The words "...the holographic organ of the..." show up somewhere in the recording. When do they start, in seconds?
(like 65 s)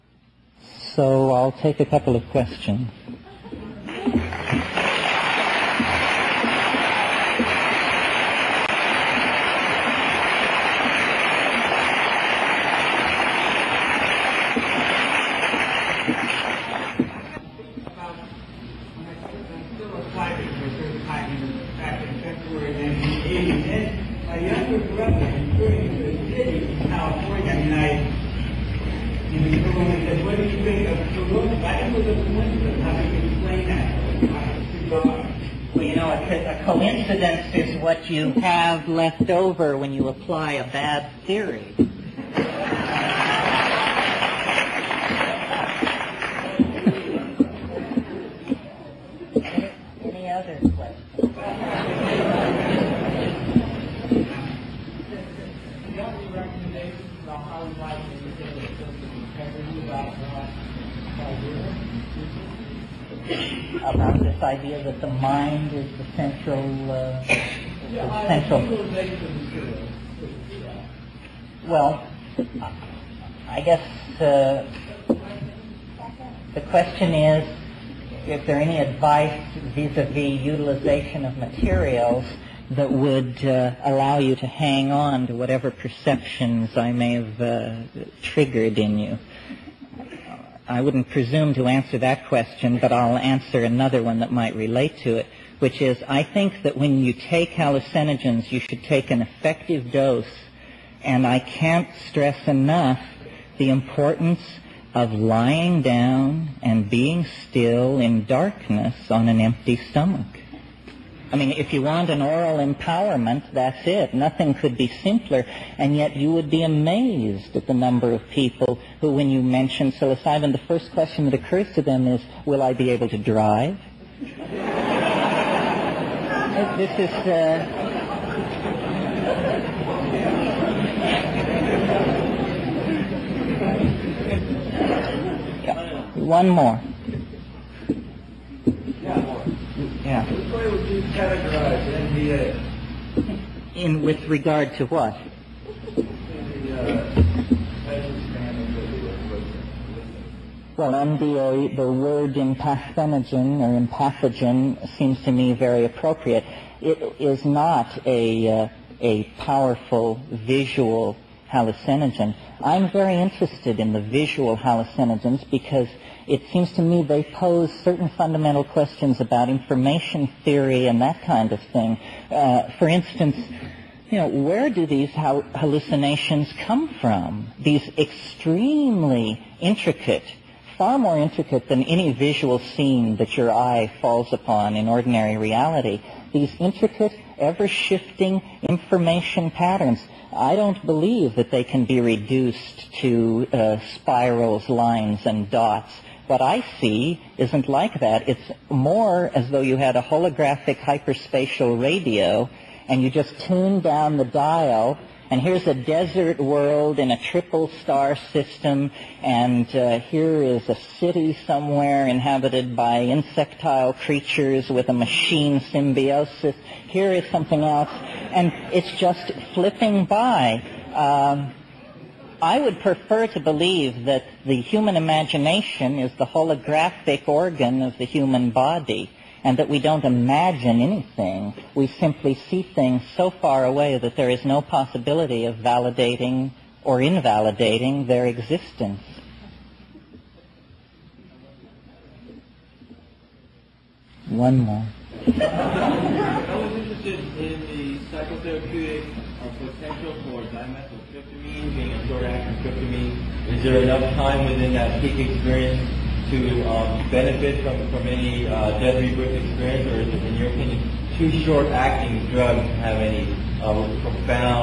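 226 s.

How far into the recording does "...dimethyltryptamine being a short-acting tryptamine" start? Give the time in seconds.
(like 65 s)
250 s.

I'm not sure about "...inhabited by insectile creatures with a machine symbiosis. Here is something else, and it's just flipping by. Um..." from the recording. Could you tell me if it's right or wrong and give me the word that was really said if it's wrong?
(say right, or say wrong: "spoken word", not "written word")
right.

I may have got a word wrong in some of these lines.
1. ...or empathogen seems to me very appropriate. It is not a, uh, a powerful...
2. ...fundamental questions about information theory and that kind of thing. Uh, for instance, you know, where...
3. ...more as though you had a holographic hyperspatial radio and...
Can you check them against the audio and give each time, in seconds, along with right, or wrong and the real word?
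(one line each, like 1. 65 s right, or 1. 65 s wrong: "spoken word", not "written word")
1. 153 s right
2. 168 s right
3. 198 s right.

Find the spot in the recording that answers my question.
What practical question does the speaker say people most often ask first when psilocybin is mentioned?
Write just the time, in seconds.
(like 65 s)
122 s.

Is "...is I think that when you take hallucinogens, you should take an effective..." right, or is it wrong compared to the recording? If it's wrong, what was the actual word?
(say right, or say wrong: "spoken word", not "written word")
right.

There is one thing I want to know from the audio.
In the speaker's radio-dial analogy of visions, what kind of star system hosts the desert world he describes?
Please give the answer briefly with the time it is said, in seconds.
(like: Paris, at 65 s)
A triple star system, at 207 s.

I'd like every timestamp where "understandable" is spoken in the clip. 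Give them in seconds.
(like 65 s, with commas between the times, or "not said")
not said.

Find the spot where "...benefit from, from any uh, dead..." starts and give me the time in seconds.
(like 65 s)
257 s.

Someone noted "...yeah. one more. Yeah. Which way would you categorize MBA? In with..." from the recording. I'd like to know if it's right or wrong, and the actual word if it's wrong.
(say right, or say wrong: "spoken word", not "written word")
wrong: "NBA", not "MBA".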